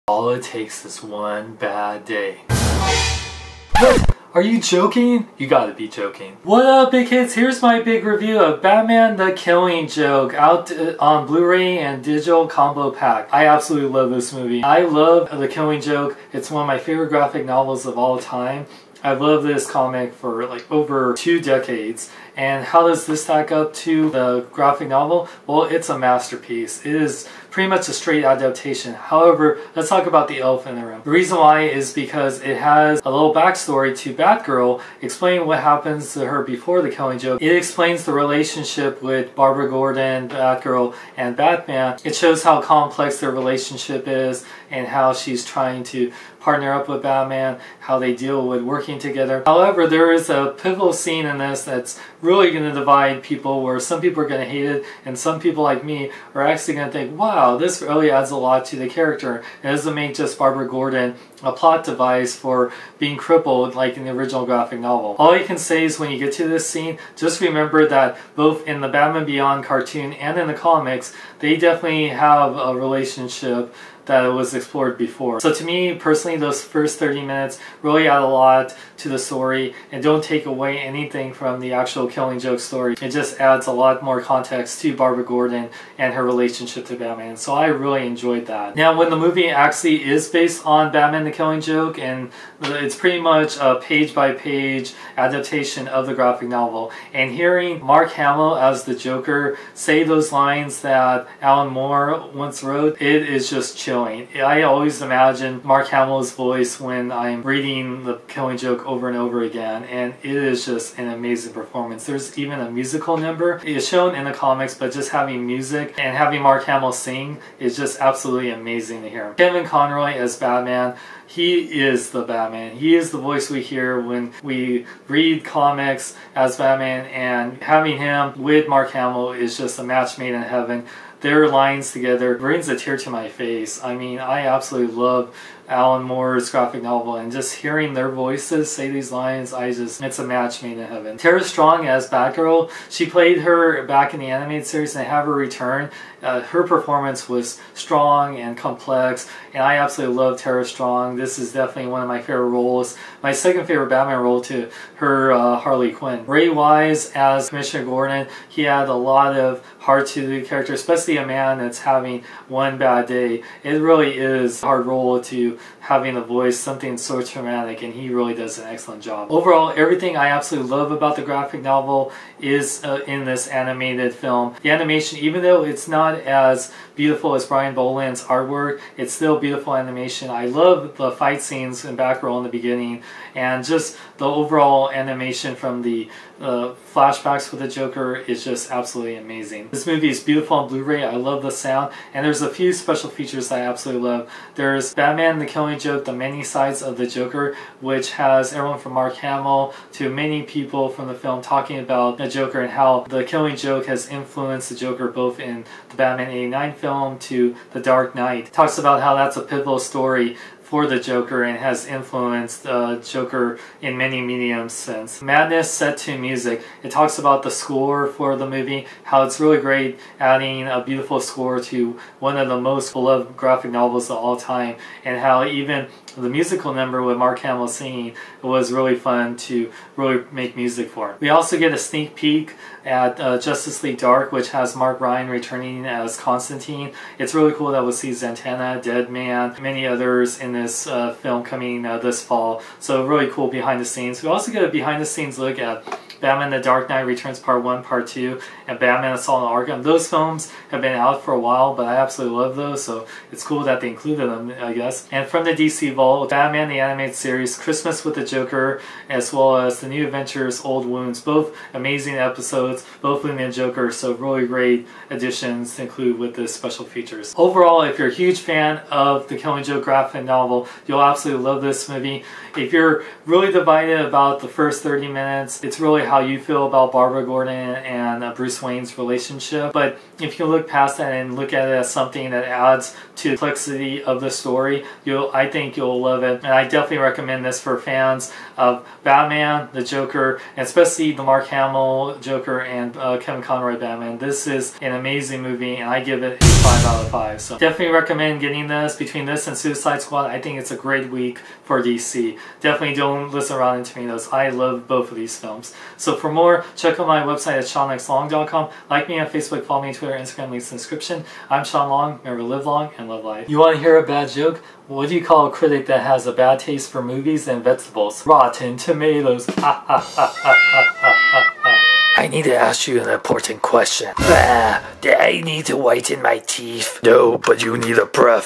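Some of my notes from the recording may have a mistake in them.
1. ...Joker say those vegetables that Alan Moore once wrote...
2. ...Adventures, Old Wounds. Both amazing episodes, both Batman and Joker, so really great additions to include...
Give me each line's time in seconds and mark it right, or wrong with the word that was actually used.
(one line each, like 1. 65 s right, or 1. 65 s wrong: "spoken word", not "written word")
1. 98 s wrong: "lines", not "vegetables"
2. 260 s right.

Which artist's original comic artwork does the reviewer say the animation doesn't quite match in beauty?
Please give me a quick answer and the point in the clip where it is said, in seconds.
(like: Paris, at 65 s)
Brian Bolland, at 177 s.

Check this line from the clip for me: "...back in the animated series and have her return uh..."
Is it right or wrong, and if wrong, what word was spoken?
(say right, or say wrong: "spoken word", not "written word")
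right.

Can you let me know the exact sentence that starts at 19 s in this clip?
I love this comic for like over two decades.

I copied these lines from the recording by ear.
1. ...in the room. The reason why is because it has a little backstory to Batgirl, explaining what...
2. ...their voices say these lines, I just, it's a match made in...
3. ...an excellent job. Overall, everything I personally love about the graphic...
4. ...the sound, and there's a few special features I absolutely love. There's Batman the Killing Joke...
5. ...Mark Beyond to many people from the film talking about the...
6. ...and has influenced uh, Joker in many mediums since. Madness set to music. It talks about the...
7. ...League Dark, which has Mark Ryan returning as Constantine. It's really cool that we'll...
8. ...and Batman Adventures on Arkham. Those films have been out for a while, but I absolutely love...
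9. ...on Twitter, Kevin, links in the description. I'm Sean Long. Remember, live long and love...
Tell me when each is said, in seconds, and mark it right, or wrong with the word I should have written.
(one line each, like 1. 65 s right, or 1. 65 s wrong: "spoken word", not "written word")
1. 30 s right
2. 137 s right
3. 168 s wrong: "absolutely", not "personally"
4. 191 s right
5. 198 s wrong: "Hamill", not "Beyond"
6. 211 s right
7. 233 s right
8. 248 s wrong: "Assault", not "Adventures"
9. 309 s wrong: "Instagram", not "Kevin".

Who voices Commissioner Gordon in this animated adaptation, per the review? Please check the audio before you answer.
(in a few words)
Ray Wise.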